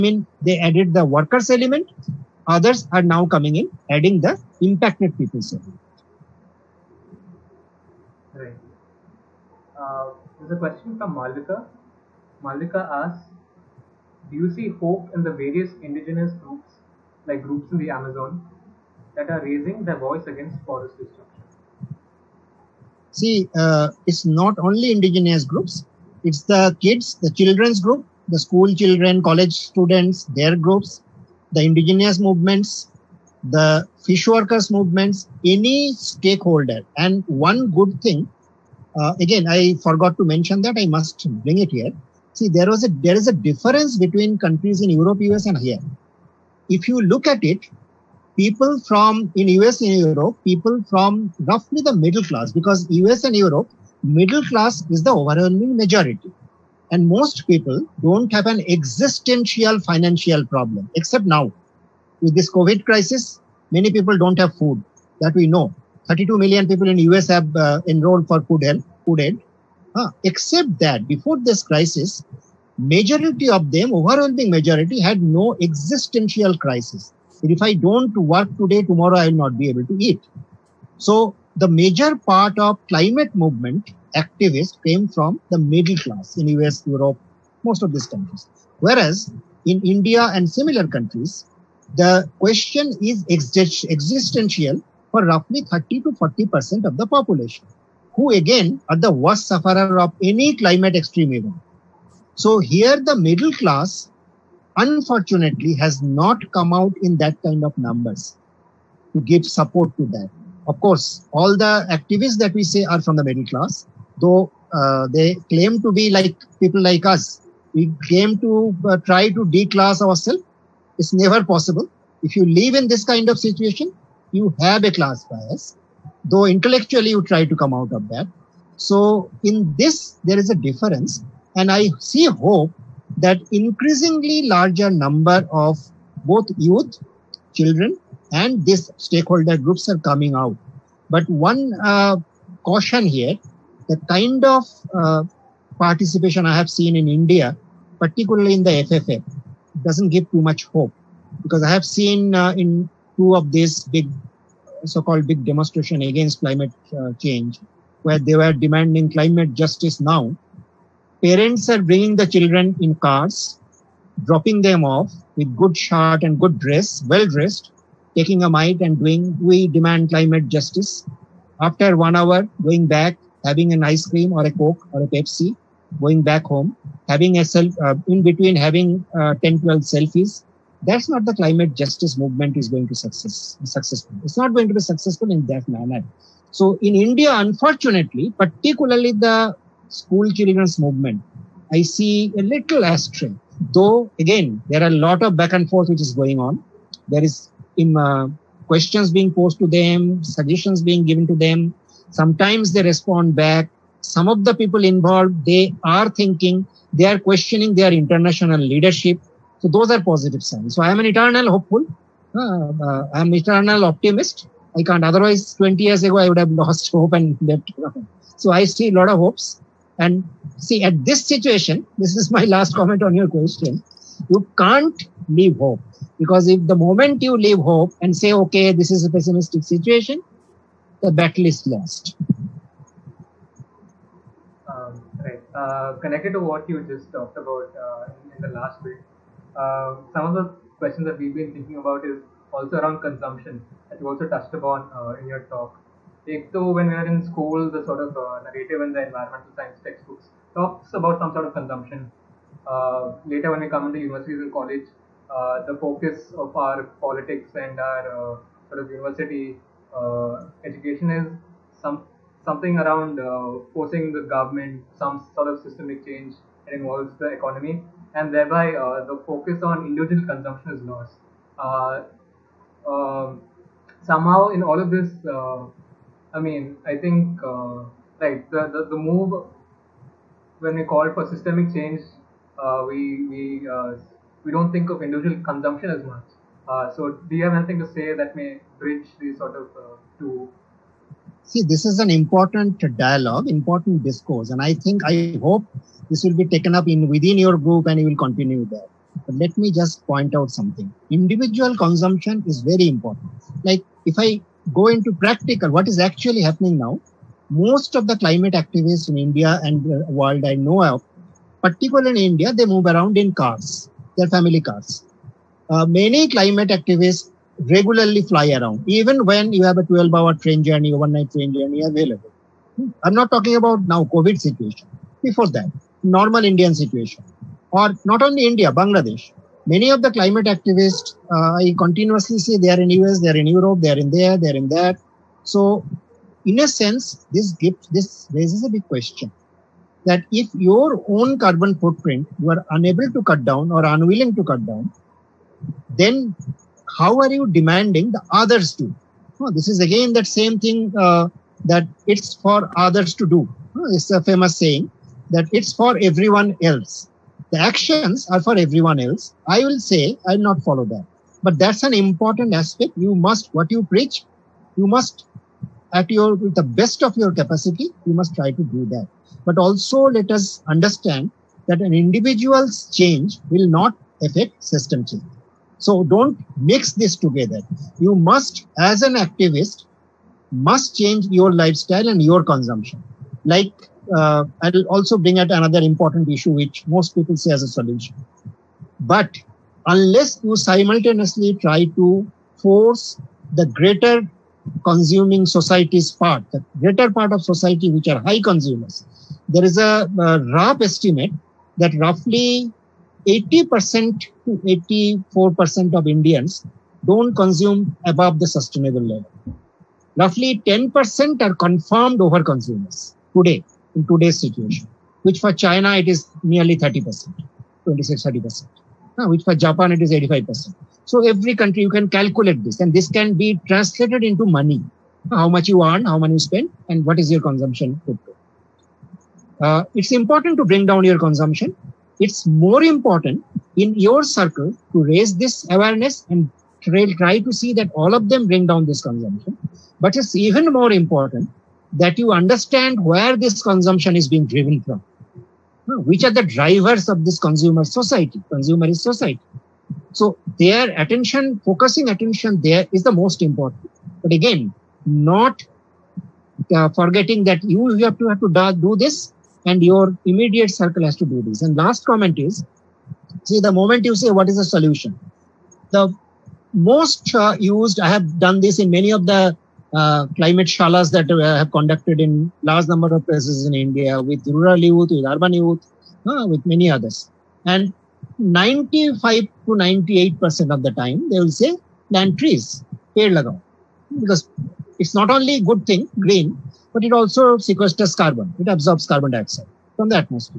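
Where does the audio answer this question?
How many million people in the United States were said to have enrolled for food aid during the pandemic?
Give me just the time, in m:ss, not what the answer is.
1:06.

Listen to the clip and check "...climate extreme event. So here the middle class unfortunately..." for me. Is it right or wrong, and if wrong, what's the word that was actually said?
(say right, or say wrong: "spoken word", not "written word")
right.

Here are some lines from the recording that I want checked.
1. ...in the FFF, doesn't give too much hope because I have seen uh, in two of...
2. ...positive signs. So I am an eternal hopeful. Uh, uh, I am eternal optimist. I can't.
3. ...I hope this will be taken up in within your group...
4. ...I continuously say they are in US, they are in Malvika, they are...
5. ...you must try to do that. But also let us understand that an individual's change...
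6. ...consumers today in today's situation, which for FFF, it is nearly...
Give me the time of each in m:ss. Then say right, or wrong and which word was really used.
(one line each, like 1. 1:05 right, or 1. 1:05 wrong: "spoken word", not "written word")
1. 2:28 right
2. 3:30 right
3. 4:55 right
4. 5:31 wrong: "Europe", not "Malvika"
5. 6:08 right
6. 6:52 wrong: "China", not "FFF".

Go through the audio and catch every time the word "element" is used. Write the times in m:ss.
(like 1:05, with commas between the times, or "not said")
0:01, 0:05.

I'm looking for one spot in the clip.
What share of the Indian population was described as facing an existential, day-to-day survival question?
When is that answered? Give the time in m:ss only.
1:35.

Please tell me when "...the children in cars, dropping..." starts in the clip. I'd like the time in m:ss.
2:42.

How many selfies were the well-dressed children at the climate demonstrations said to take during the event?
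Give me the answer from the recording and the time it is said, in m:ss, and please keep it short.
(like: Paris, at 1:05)
10 to 12, at 2:59.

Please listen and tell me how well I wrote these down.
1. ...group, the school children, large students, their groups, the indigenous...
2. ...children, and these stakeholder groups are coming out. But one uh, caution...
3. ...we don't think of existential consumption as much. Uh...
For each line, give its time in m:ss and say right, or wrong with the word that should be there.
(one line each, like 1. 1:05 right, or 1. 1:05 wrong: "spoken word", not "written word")
1. 0:27 wrong: "college", not "large"
2. 2:17 right
3. 4:44 wrong: "individual", not "existential".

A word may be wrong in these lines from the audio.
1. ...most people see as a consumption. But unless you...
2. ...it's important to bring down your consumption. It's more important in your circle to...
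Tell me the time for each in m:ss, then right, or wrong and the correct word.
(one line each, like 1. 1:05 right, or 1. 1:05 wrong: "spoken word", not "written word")
1. 6:26 wrong: "solution", not "consumption"
2. 7:09 right.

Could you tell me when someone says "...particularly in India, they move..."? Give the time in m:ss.
5:11.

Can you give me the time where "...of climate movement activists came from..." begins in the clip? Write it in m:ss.
1:22.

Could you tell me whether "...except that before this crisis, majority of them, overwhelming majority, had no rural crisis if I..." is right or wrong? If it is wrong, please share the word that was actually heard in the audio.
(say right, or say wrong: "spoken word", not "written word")
wrong: "existential", not "rural".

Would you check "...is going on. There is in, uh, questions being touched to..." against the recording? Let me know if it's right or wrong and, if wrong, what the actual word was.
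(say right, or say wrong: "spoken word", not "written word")
wrong: "posed", not "touched".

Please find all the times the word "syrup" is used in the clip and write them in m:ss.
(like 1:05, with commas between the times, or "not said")
not said.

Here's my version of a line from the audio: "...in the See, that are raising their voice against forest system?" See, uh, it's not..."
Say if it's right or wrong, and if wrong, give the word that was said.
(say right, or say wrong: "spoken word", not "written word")
wrong: "Amazon", not "See".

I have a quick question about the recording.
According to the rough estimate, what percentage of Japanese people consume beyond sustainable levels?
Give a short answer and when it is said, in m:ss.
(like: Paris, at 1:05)
85%, at 7:00.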